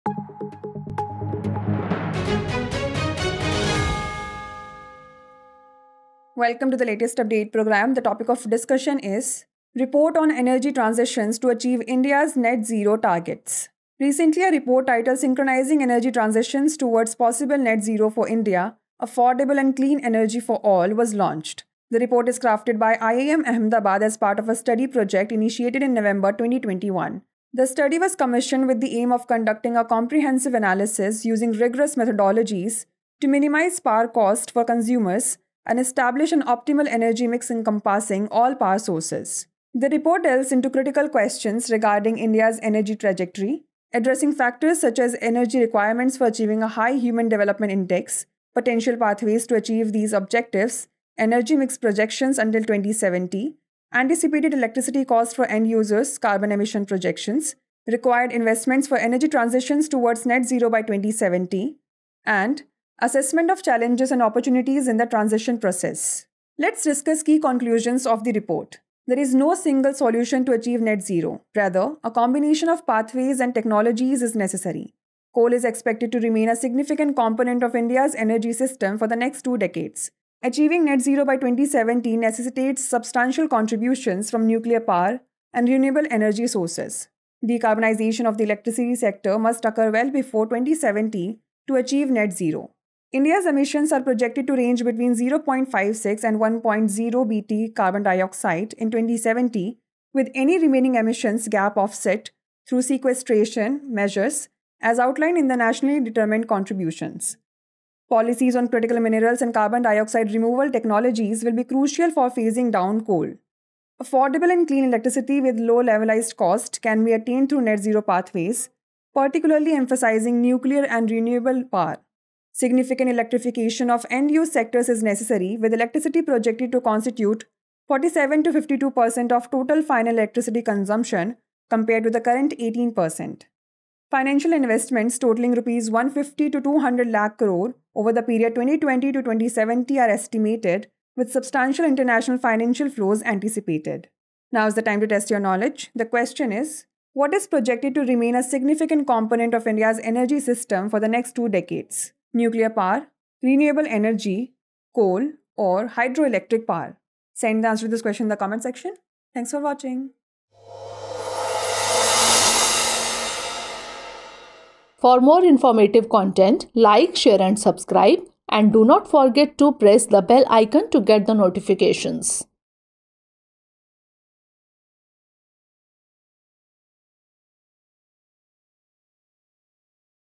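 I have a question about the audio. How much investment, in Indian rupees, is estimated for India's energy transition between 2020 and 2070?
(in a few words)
150 to 200 lakh crore.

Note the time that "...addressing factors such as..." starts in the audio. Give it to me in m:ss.
0:43.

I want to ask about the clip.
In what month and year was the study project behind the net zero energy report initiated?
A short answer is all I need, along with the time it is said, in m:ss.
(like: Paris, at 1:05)
November 2021, at 0:25.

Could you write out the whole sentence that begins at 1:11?
Rather, a combination of pathways and technologies is necessary.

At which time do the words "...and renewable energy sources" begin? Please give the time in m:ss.
1:25.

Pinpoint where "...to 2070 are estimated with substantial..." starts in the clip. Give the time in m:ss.
2:19.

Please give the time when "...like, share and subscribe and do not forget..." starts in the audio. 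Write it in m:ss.
2:46.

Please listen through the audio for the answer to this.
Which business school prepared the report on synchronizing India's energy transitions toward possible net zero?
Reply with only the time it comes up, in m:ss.
0:22.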